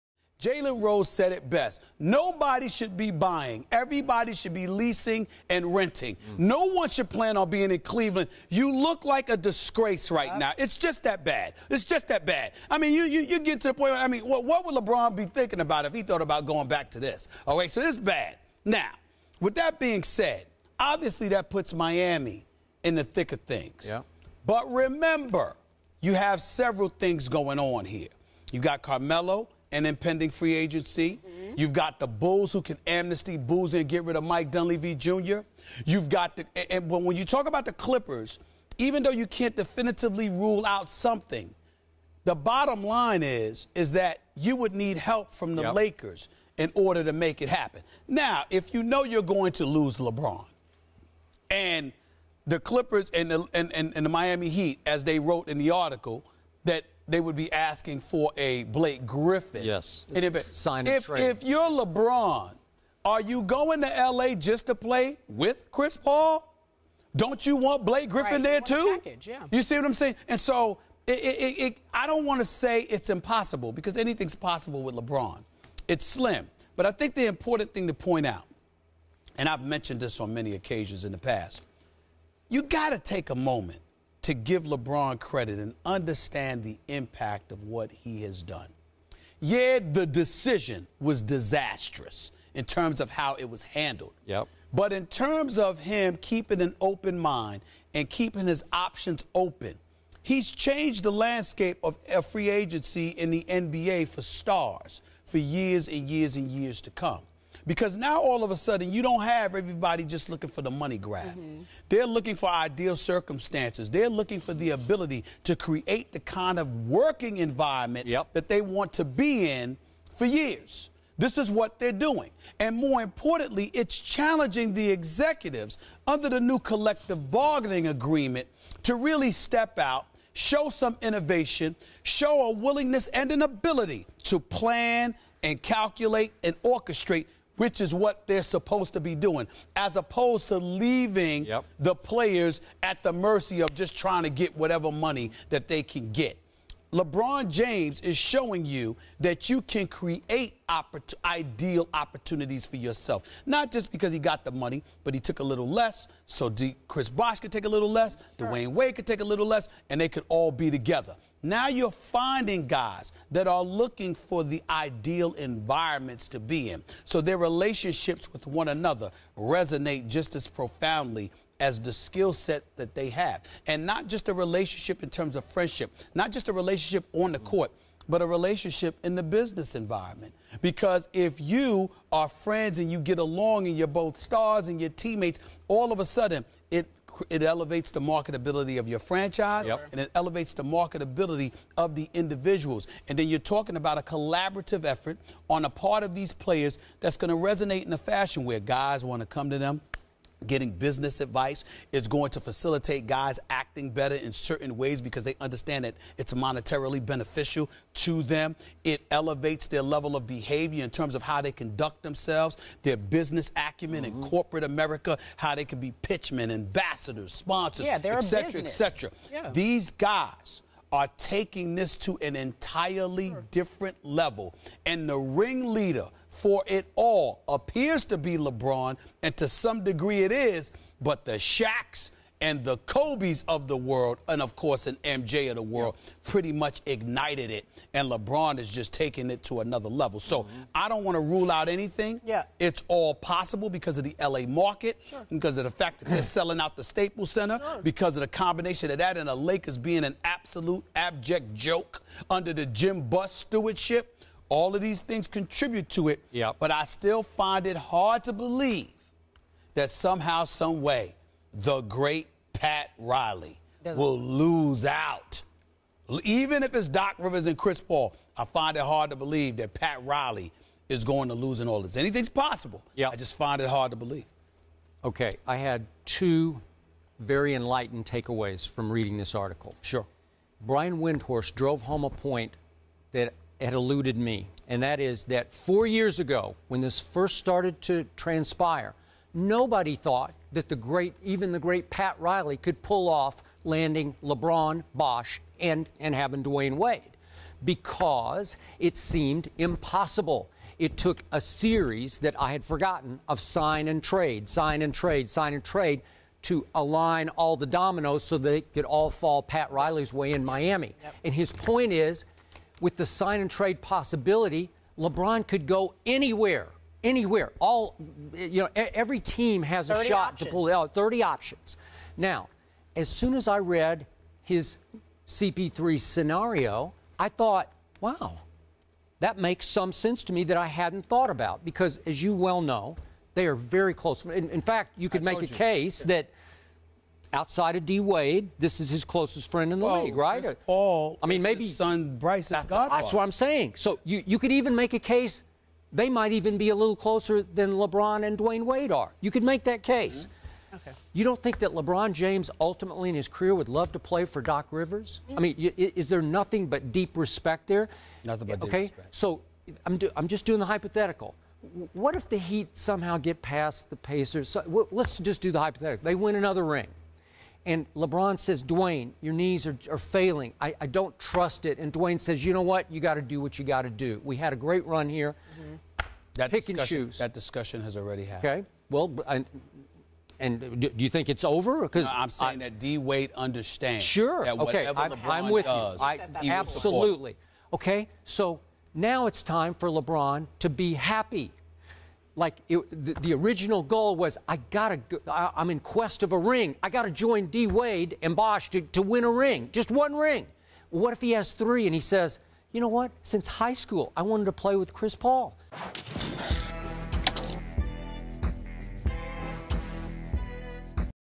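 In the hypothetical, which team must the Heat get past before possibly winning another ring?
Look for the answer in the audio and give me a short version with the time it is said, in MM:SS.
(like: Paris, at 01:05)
Pacers, at 06:03.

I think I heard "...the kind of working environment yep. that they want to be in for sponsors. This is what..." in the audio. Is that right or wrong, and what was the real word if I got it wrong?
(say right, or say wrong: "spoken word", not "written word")
wrong: "years", not "sponsors".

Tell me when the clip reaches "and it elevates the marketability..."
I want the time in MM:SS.
03:09.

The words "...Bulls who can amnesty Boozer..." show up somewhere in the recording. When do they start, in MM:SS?
00:32.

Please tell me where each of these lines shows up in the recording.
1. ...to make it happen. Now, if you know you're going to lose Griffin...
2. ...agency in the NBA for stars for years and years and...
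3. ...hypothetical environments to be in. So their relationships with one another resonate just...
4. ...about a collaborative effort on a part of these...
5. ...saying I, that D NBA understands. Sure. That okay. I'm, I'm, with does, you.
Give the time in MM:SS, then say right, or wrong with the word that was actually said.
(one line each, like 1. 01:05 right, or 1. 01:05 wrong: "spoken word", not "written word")
1. 00:47 wrong: "LeBron", not "Griffin"
2. 01:42 right
3. 02:44 wrong: "ideal", not "hypothetical"
4. 03:13 right
5. 06:22 wrong: "Wade", not "NBA".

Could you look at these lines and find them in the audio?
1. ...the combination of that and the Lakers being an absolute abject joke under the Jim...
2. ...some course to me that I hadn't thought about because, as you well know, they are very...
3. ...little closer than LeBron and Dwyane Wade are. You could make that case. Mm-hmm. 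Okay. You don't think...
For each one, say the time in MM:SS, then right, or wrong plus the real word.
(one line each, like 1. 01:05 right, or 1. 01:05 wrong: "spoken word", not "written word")
1. 04:08 right
2. 05:29 wrong: "sense", not "course"
3. 05:46 right.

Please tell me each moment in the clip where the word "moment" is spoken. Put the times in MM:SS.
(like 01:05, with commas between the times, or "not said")
01:23.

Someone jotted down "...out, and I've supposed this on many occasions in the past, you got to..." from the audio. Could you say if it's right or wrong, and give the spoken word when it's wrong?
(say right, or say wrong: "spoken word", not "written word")
wrong: "mentioned", not "supposed".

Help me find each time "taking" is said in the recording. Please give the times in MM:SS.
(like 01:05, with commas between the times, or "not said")
03:41, 03:58.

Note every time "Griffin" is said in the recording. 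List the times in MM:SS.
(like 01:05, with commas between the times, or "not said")
00:59, 01:08.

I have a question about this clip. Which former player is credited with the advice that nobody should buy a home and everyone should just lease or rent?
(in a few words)
Jalen Rose.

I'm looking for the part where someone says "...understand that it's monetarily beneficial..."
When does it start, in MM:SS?
03:25.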